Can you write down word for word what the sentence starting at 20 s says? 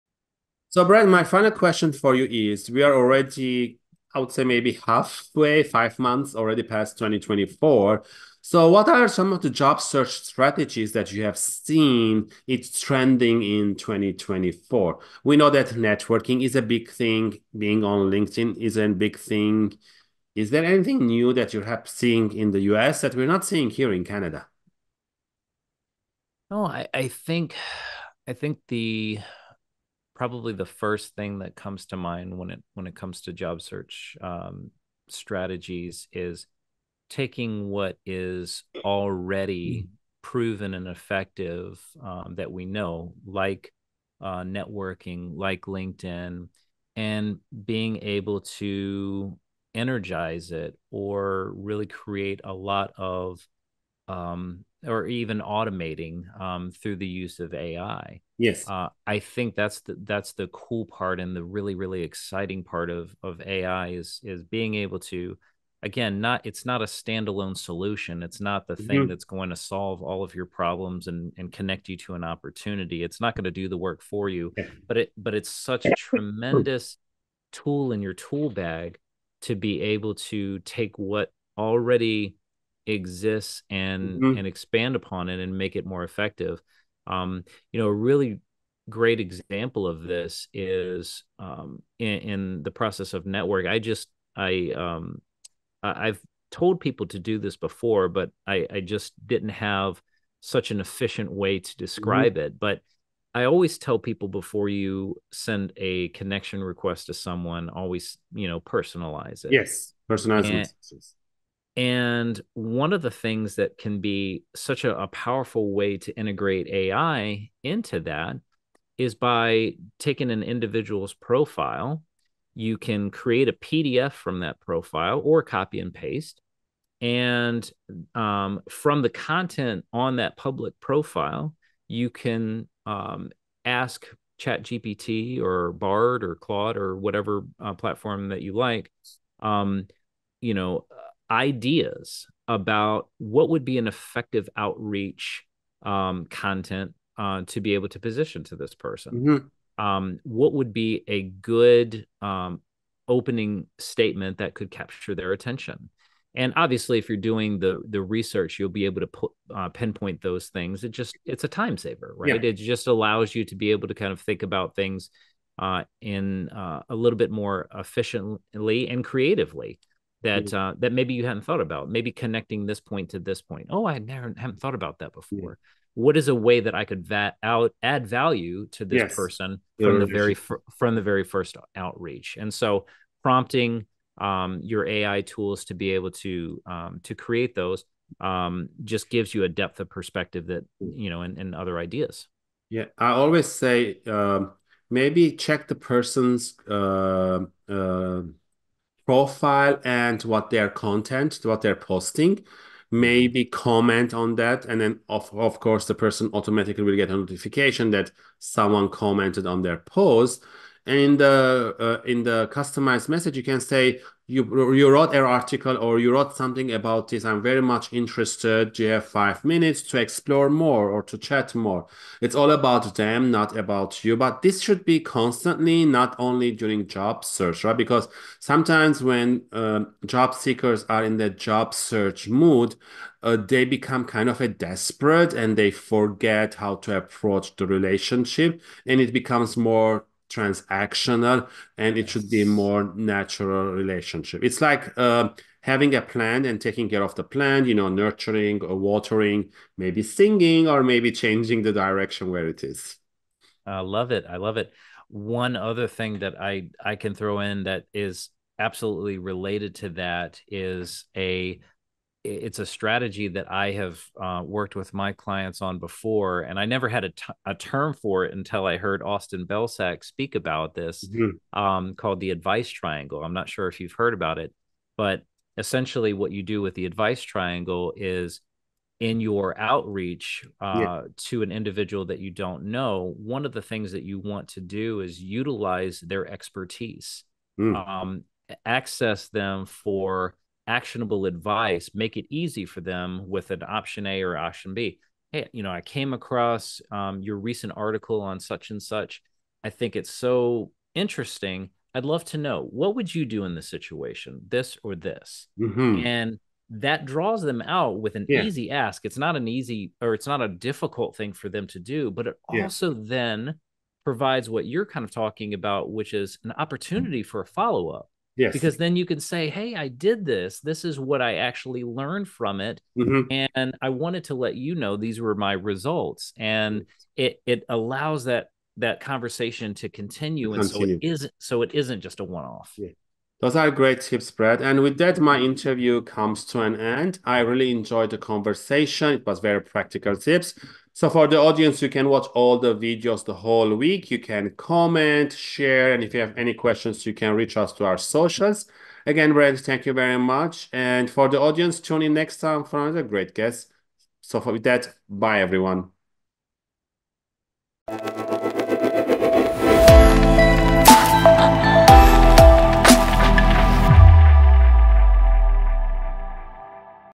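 Is there anything new that you have seeing in the US that we're not seeing here in Canada?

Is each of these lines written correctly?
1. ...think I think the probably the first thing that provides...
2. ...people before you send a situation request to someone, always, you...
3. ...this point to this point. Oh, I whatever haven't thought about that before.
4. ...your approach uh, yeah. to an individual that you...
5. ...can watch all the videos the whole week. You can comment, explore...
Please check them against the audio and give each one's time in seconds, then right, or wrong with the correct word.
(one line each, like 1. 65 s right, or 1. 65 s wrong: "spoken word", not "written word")
1. 27 s wrong: "comes", not "provides"
2. 103 s wrong: "connection", not "situation"
3. 172 s wrong: "never", not "whatever"
4. 279 s wrong: "outreach", not "approach"
5. 341 s wrong: "share", not "explore".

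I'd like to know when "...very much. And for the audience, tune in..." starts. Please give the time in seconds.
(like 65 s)
349 s.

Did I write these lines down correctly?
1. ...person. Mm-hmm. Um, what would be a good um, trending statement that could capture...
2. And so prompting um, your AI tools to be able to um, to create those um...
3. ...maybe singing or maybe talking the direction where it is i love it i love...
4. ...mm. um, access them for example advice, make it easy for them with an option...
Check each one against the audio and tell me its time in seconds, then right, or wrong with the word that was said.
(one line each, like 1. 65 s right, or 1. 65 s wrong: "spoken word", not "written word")
1. 148 s wrong: "opening", not "trending"
2. 182 s right
3. 249 s wrong: "changing", not "talking"
4. 287 s wrong: "actionable", not "example".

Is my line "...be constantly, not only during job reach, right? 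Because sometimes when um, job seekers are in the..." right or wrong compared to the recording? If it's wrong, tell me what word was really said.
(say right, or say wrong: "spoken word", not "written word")
wrong: "search", not "reach".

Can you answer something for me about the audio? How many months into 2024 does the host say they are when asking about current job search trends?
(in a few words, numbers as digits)
5.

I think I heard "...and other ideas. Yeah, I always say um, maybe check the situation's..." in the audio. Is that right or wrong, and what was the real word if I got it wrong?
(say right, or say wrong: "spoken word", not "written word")
wrong: "person", not "situation".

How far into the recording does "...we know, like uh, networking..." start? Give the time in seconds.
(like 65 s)
42 s.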